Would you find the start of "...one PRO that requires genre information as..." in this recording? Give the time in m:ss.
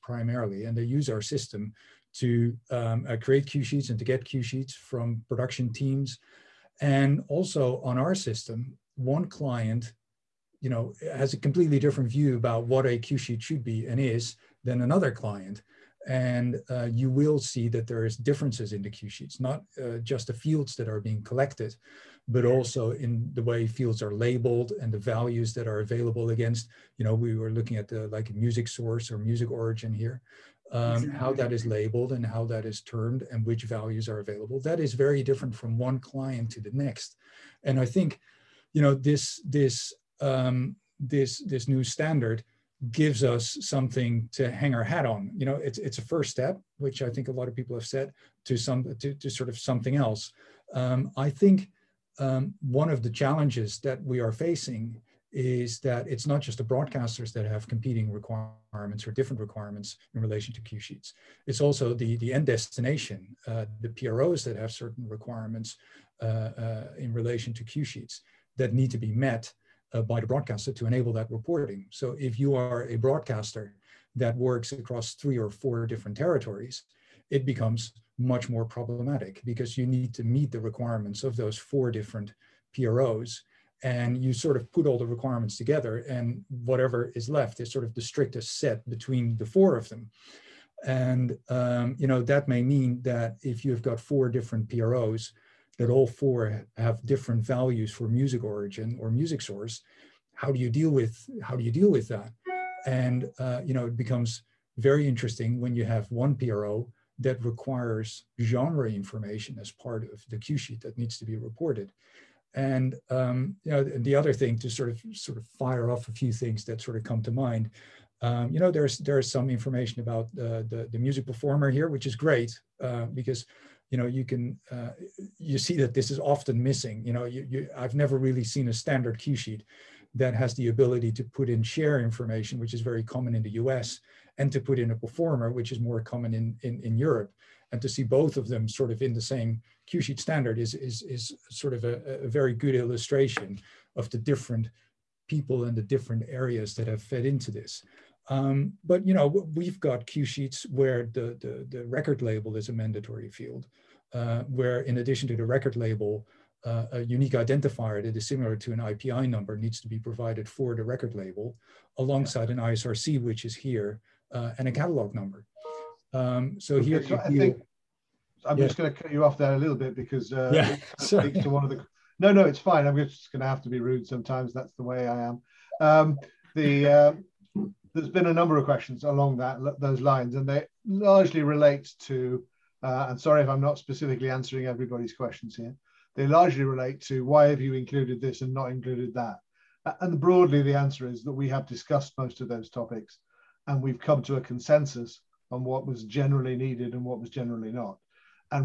1:46.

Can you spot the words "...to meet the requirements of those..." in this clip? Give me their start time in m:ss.
1:20.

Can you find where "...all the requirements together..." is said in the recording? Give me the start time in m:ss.
1:24.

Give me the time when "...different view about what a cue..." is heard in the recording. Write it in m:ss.
0:11.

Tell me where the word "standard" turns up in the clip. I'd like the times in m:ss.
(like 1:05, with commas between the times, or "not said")
0:41, 2:08, 2:20.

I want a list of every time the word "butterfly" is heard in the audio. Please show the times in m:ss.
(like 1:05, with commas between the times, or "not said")
not said.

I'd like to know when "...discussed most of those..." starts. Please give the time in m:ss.
3:11.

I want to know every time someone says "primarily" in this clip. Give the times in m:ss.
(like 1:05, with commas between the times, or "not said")
0:00.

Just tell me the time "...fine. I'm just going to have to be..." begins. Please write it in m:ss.
2:52.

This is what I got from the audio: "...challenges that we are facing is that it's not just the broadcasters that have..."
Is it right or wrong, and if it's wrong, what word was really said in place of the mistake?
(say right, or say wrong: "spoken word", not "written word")
right.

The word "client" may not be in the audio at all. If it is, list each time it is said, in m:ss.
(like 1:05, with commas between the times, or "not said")
0:09, 0:15, 0:35.